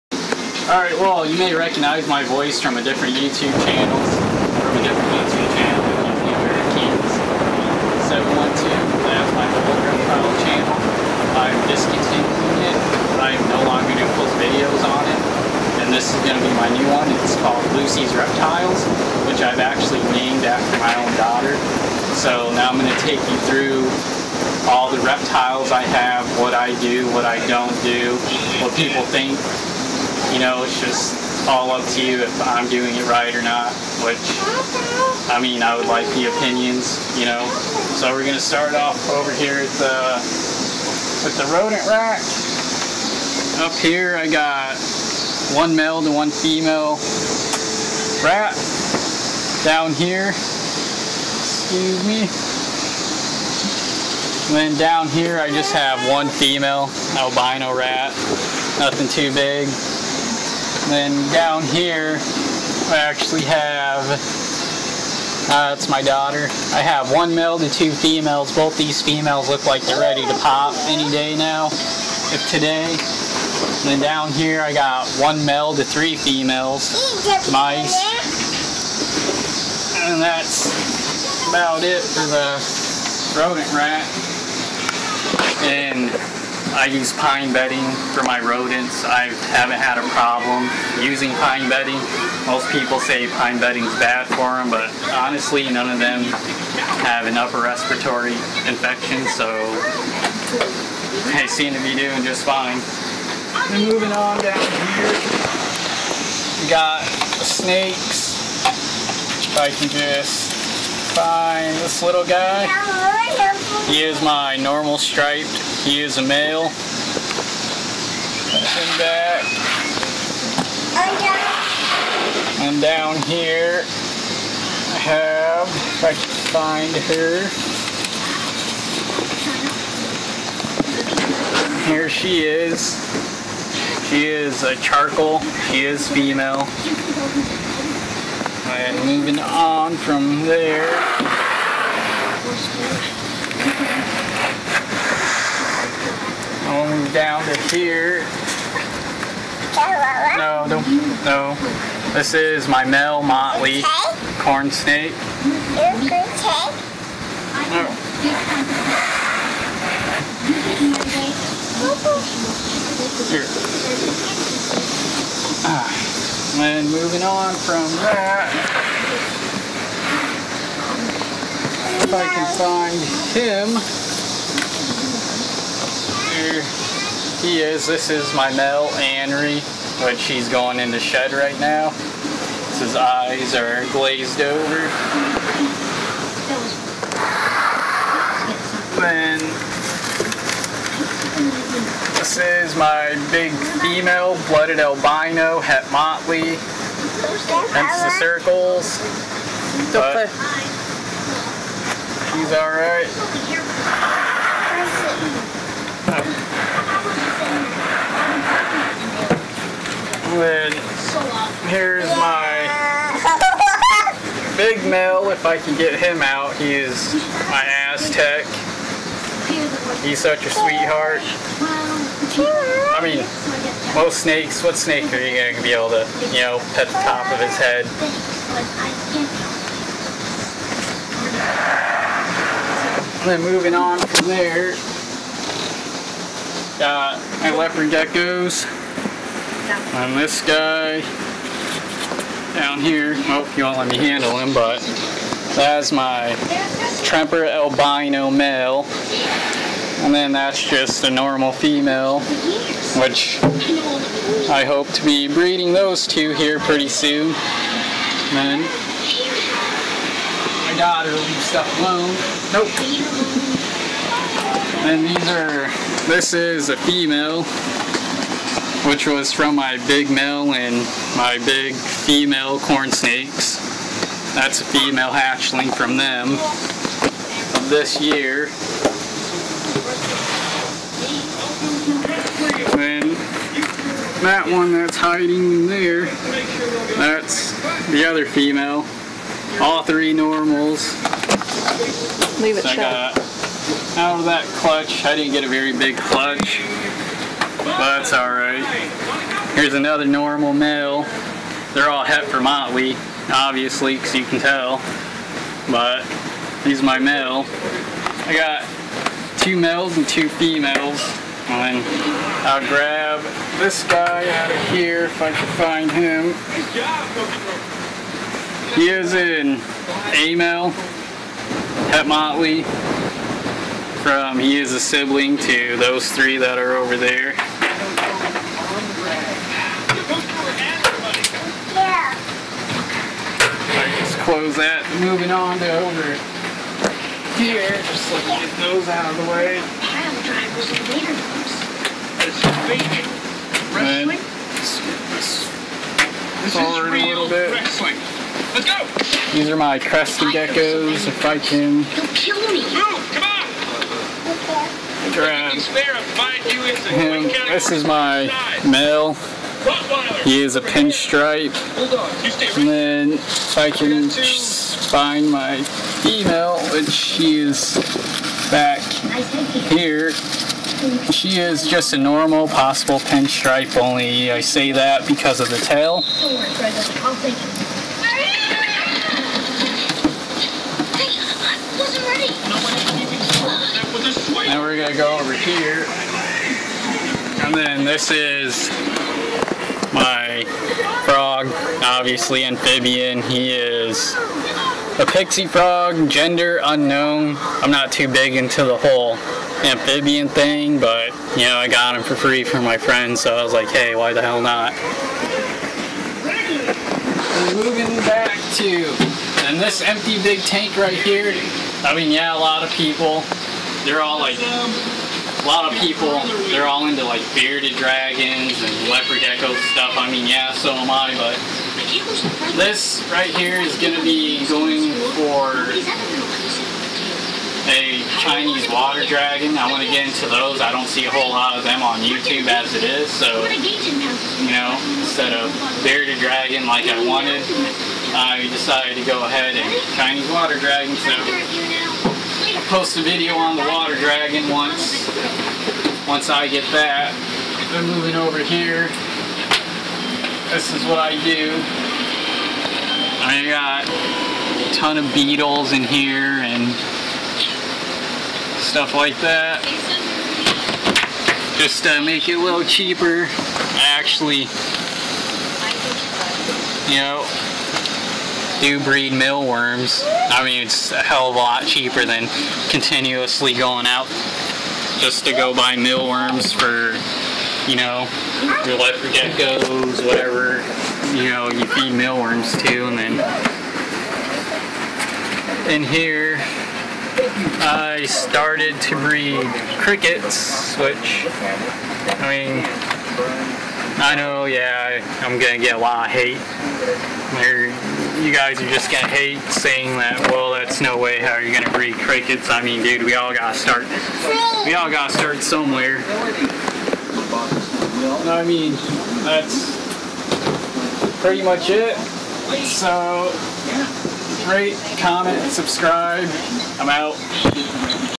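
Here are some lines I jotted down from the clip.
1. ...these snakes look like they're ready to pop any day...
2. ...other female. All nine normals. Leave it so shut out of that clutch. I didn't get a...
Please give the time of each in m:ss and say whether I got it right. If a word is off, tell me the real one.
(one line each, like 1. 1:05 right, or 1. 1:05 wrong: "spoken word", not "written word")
1. 1:08 wrong: "females", not "snakes"
2. 4:48 wrong: "three", not "nine".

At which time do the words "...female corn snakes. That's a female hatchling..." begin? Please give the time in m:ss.
4:31.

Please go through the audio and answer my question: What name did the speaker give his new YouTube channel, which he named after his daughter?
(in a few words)
Lucy's Reptiles.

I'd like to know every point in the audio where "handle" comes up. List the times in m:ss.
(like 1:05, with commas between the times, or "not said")
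4:03.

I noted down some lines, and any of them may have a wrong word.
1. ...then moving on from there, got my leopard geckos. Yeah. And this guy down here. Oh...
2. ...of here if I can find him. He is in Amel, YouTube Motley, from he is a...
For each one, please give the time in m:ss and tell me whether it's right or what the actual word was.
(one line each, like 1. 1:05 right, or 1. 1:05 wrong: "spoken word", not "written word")
1. 3:53 right
2. 5:14 wrong: "Het", not "YouTube".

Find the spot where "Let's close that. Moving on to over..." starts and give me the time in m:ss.
5:33.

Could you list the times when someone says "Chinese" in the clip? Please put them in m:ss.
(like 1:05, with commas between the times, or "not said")
7:08, 7:19.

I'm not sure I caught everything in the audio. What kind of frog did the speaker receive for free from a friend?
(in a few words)
Pixie frog.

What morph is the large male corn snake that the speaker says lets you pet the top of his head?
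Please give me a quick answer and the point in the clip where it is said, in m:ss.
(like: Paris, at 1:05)
Aztec, at 3:37.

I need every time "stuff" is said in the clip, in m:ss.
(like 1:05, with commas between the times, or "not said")
4:21, 6:59, 7:38.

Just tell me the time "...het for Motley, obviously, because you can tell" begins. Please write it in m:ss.
5:02.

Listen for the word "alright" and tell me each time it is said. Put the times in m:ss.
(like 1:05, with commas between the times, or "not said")
0:00, 3:22, 4:58.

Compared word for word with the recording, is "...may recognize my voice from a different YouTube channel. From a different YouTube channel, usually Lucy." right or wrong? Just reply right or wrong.
wrong.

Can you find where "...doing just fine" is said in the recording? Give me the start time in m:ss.
1:41.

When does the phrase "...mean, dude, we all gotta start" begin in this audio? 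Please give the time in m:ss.
8:22.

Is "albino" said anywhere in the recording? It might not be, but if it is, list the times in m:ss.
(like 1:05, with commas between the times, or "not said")
0:57, 3:14, 4:07.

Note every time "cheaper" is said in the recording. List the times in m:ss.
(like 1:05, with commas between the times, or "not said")
7:42, 7:51.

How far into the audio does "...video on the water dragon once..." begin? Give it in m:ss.
7:23.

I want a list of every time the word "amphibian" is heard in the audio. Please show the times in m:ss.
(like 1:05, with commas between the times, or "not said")
6:32, 6:39.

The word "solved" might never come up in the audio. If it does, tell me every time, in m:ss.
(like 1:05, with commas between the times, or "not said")
not said.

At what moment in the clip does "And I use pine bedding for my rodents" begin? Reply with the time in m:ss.
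1:25.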